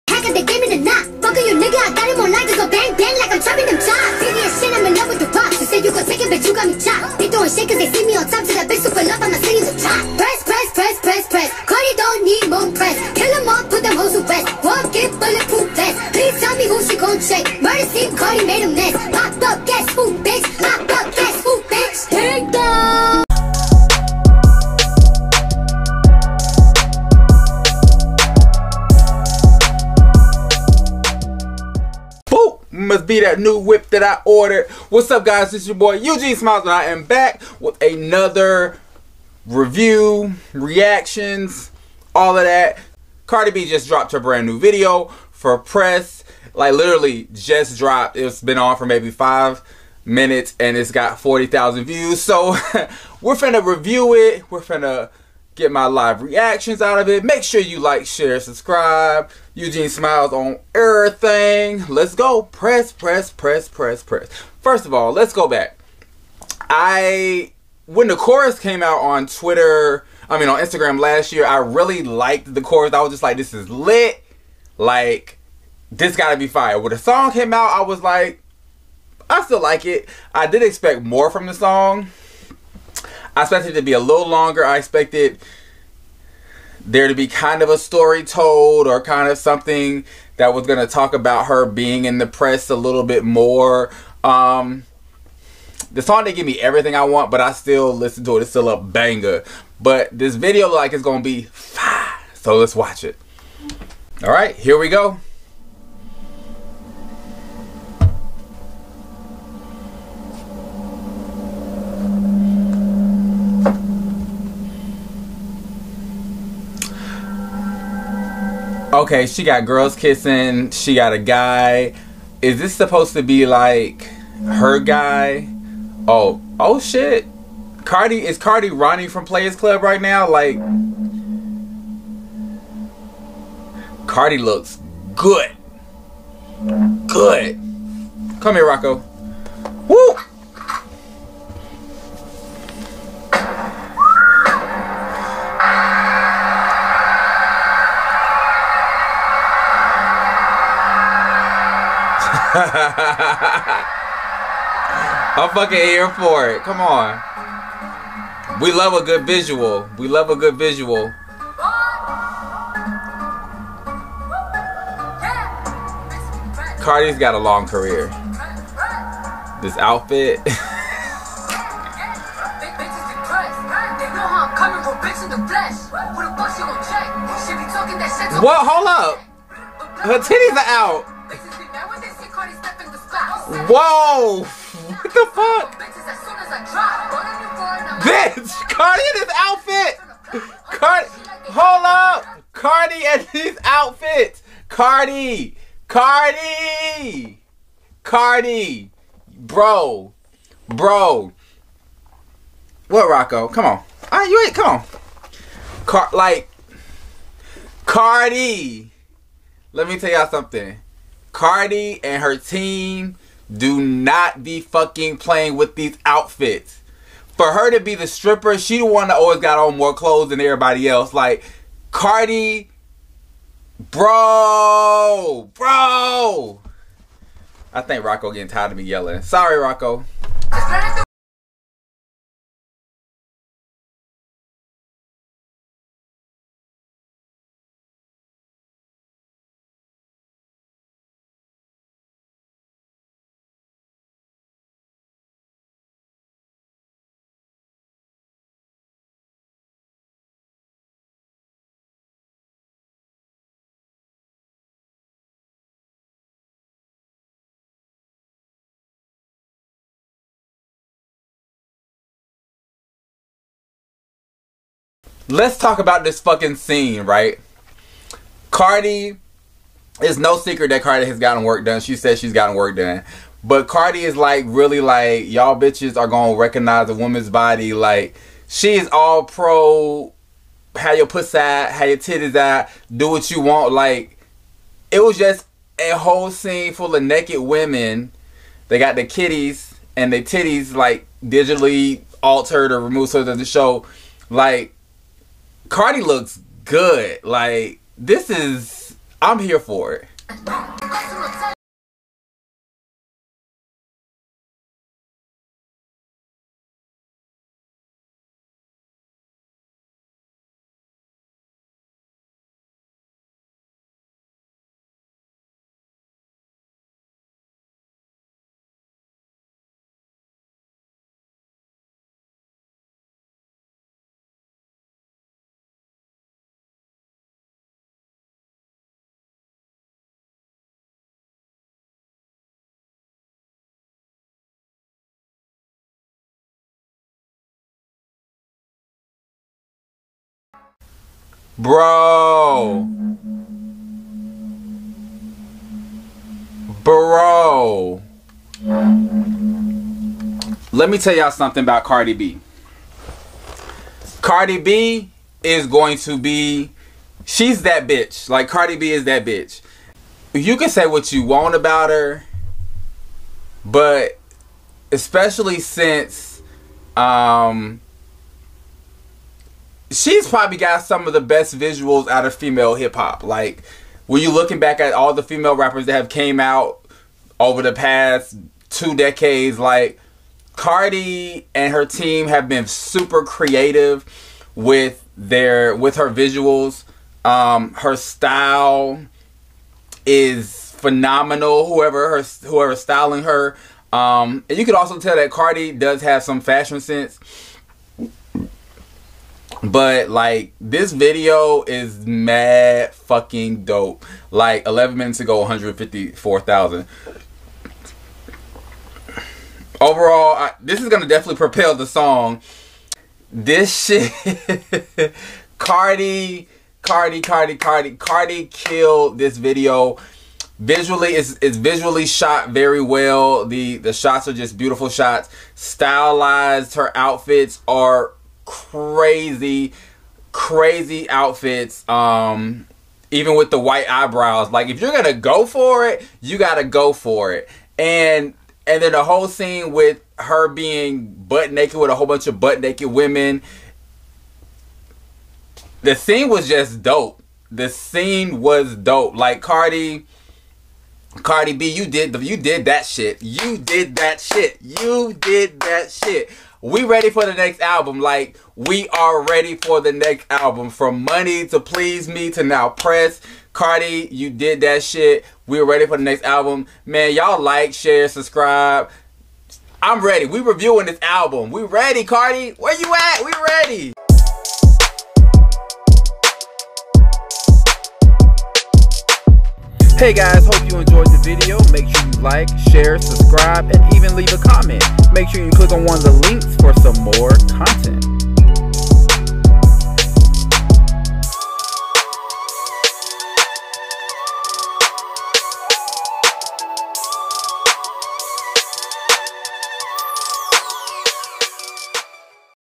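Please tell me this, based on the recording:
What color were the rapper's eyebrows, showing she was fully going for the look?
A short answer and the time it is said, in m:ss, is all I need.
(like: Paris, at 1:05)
White, at 7:13.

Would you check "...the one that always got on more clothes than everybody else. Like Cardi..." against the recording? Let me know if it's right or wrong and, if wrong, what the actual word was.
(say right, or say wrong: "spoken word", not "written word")
right.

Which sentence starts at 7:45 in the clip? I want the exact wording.
We're ready for the next album.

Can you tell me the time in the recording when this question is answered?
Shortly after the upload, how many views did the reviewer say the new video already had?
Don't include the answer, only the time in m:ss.
0:51.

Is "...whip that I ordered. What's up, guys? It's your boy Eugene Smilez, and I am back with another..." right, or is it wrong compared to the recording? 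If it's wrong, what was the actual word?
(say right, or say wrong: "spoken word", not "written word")
right.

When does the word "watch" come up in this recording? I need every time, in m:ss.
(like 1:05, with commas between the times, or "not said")
1:42.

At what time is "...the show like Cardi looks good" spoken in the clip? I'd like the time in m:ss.
4:53.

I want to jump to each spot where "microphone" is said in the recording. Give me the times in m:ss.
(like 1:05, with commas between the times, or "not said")
not said.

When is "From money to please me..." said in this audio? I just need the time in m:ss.
7:40.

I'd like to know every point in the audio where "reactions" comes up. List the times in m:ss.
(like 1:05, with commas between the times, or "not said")
0:40, 0:56.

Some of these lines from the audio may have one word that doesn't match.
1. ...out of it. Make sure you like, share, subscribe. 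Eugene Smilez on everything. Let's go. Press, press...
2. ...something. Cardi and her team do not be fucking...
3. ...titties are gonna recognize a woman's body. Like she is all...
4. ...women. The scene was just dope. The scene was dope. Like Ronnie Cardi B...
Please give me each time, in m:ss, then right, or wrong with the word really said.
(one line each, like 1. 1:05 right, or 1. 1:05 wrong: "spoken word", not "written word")
1. 0:56 right
2. 3:30 right
3. 4:35 wrong: "bitches", not "titties"
4. 7:22 wrong: "Cardi", not "Ronnie".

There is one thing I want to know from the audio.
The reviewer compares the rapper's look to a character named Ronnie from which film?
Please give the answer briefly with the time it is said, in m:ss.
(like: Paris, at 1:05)
Players Club, at 2:09.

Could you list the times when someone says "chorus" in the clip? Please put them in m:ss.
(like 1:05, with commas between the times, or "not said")
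1:08, 1:12.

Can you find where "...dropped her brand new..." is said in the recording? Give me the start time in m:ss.
0:43.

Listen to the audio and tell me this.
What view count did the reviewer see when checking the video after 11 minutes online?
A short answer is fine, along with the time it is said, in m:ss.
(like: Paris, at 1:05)
154,000, at 6:45.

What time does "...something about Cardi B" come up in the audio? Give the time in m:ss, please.
5:51.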